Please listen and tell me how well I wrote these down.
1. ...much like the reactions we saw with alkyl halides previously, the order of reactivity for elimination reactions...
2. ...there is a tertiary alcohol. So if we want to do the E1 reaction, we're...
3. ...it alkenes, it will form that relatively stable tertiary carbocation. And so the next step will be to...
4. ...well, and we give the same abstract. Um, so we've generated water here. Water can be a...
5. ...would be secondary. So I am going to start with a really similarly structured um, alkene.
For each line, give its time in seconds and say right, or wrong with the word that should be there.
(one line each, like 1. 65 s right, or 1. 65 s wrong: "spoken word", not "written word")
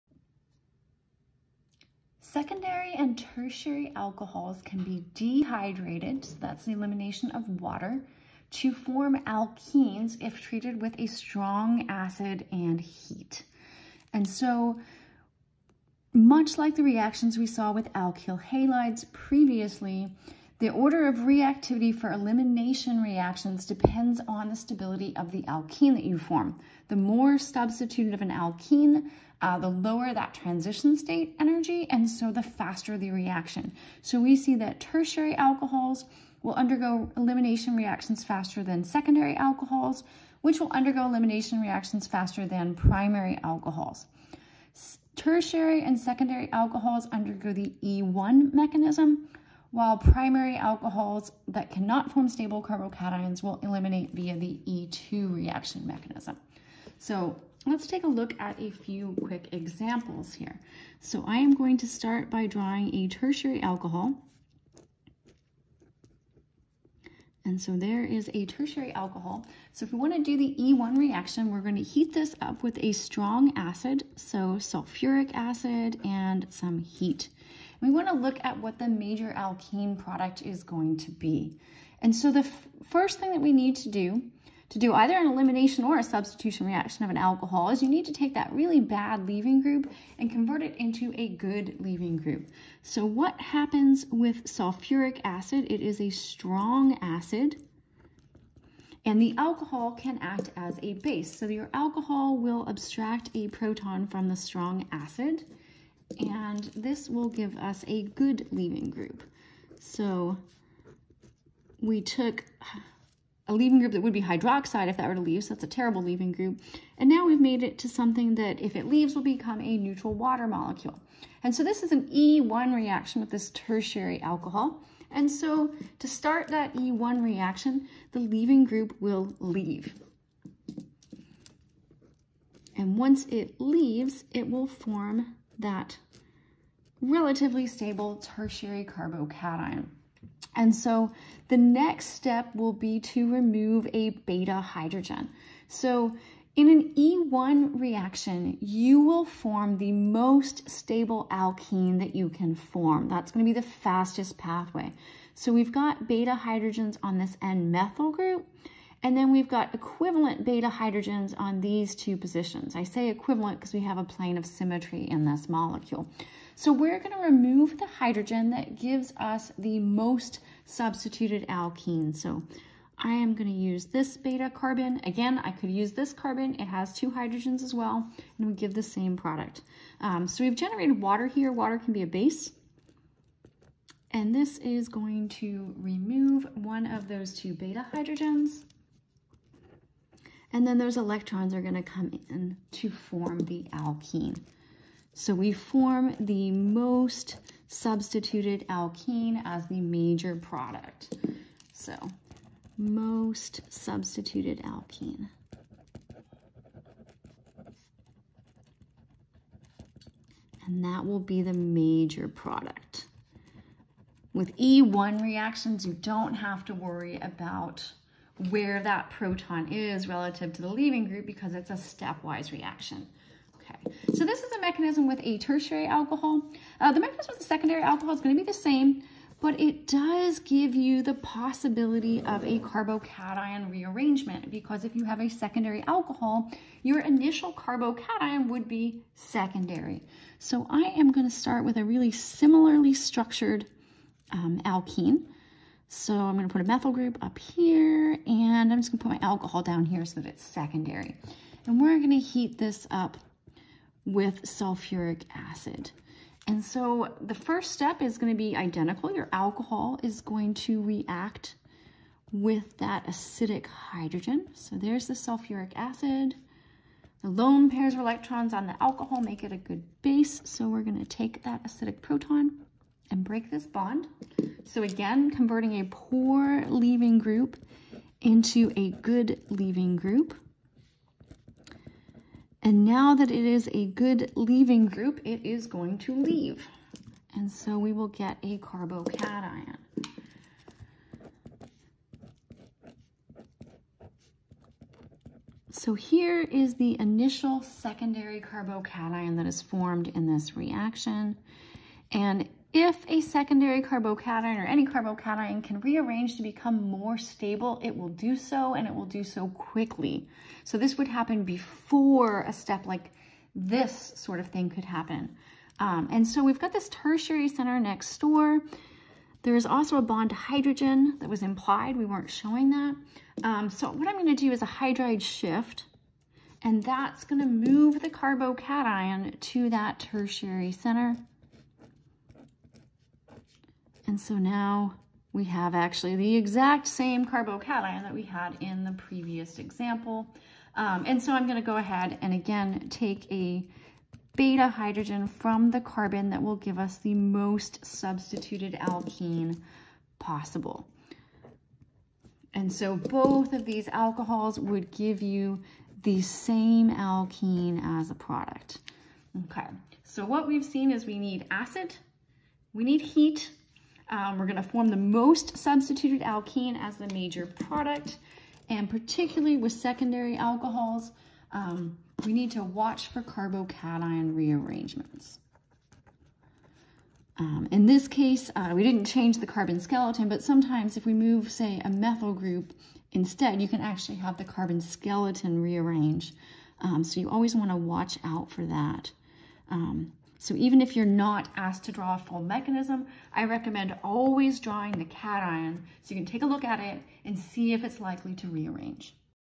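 1. 16 s right
2. 67 s right
3. 133 s wrong: "leaves", not "alkenes"
4. 177 s wrong: "product", not "abstract"
5. 238 s right.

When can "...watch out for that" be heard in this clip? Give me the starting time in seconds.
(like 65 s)
387 s.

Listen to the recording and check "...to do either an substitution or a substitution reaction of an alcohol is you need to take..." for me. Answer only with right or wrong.
wrong.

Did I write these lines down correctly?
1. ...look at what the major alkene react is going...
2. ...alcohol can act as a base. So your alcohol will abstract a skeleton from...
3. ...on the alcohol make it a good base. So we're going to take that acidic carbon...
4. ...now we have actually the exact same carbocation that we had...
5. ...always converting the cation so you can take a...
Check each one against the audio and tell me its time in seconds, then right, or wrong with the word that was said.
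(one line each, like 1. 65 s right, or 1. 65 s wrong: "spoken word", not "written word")
1. 78 s wrong: "product", not "react"
2. 99 s wrong: "proton", not "skeleton"
3. 268 s wrong: "proton", not "carbon"
4. 334 s right
5. 394 s wrong: "drawing", not "converting".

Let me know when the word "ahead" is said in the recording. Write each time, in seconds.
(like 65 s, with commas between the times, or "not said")
341 s.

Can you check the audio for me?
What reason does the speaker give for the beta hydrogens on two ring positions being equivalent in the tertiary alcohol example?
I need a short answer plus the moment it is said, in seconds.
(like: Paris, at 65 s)
Plane of symmetry, at 164 s.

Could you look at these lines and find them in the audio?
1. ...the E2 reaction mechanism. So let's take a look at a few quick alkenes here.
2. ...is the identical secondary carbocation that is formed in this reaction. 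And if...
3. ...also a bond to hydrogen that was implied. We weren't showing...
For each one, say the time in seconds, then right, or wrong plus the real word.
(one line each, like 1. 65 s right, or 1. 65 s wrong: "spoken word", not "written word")
1. 54 s wrong: "examples", not "alkenes"
2. 296 s wrong: "initial", not "identical"
3. 319 s right.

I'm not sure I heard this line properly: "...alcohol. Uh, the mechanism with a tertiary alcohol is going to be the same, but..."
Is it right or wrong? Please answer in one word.
wrong.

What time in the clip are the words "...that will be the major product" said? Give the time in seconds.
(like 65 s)
210 s.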